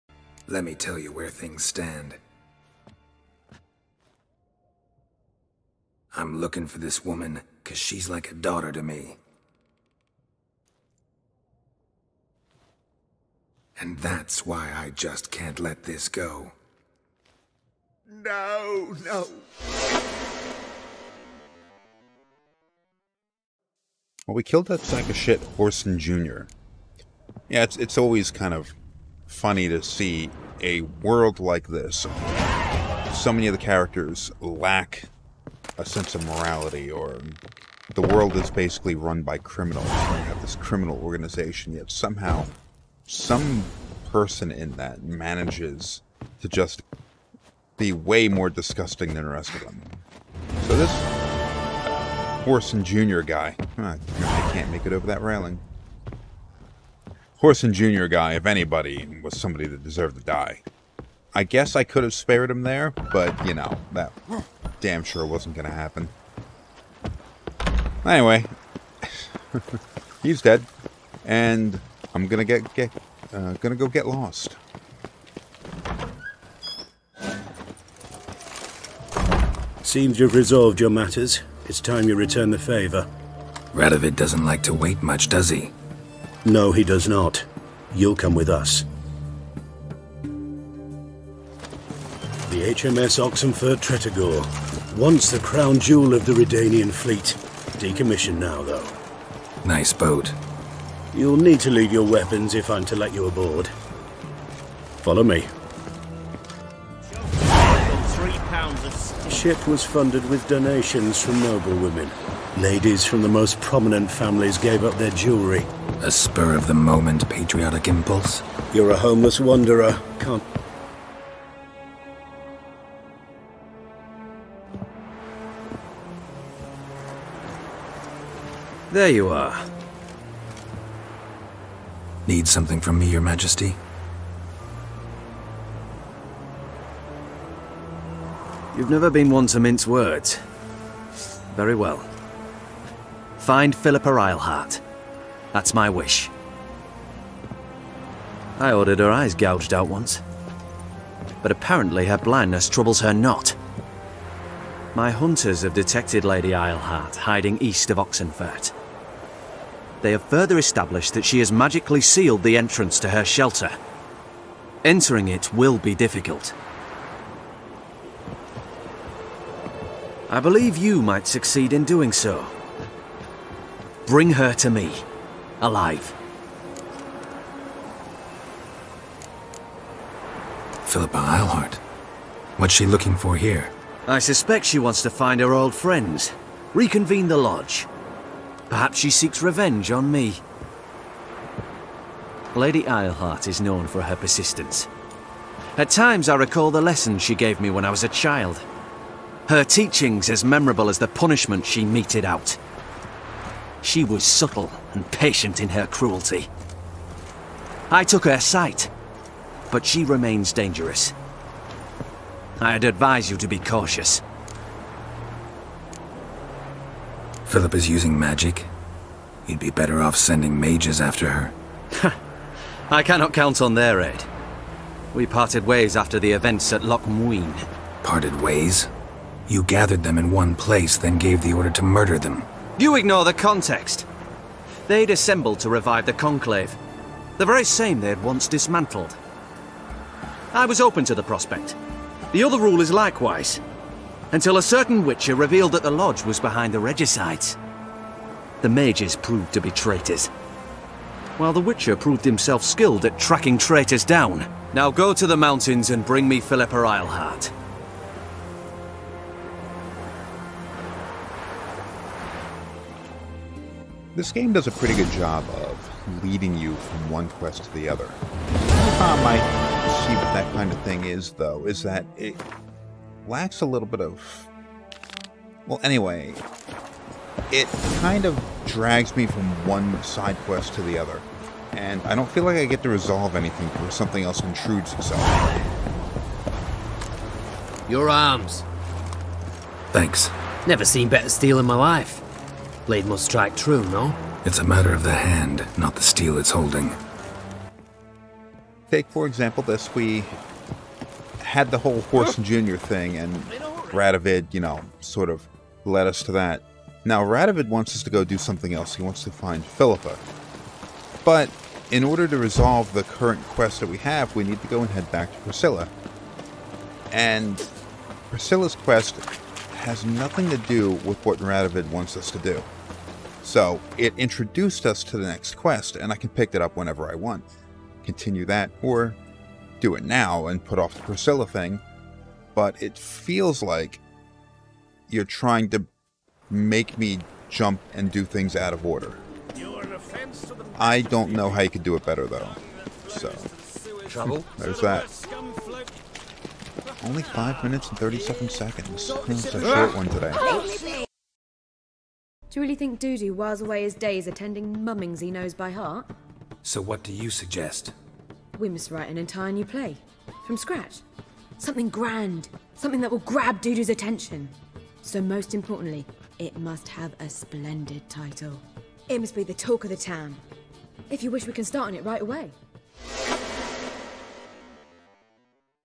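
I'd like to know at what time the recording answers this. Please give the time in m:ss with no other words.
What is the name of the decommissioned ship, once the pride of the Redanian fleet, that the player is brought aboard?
1:32.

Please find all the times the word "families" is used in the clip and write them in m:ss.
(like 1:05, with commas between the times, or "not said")
1:54.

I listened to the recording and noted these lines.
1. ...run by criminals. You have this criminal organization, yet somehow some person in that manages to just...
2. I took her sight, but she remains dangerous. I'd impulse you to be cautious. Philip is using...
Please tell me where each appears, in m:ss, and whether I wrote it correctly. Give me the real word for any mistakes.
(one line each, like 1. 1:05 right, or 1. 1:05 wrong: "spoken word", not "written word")
1. 0:38 right
2. 3:27 wrong: "advise", not "impulse".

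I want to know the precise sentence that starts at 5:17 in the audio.
And Priscilla's quest has nothing to do with what Radovid wants us to do.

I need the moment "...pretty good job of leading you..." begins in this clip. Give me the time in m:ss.
4:24.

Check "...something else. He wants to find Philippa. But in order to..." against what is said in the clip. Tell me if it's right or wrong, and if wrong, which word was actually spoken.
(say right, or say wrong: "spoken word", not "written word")
right.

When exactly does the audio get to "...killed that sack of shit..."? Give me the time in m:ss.
0:24.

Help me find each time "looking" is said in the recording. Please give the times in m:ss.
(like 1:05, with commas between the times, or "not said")
0:06, 3:02.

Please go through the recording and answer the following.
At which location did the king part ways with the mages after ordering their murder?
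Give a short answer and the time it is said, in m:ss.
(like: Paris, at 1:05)
Loch Muine, at 3:46.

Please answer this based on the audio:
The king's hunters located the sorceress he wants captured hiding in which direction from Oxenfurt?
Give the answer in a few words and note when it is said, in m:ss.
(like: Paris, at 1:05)
east, at 2:37.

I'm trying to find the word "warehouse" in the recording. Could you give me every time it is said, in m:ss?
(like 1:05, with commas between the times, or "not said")
not said.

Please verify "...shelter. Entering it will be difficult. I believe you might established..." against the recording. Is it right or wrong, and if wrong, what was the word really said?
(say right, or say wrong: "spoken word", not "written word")
wrong: "succeed", not "established".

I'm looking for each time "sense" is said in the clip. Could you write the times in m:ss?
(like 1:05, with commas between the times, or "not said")
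0:35.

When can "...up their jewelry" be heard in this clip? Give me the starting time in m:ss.
1:54.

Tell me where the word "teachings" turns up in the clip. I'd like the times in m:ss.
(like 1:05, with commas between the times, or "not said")
3:19.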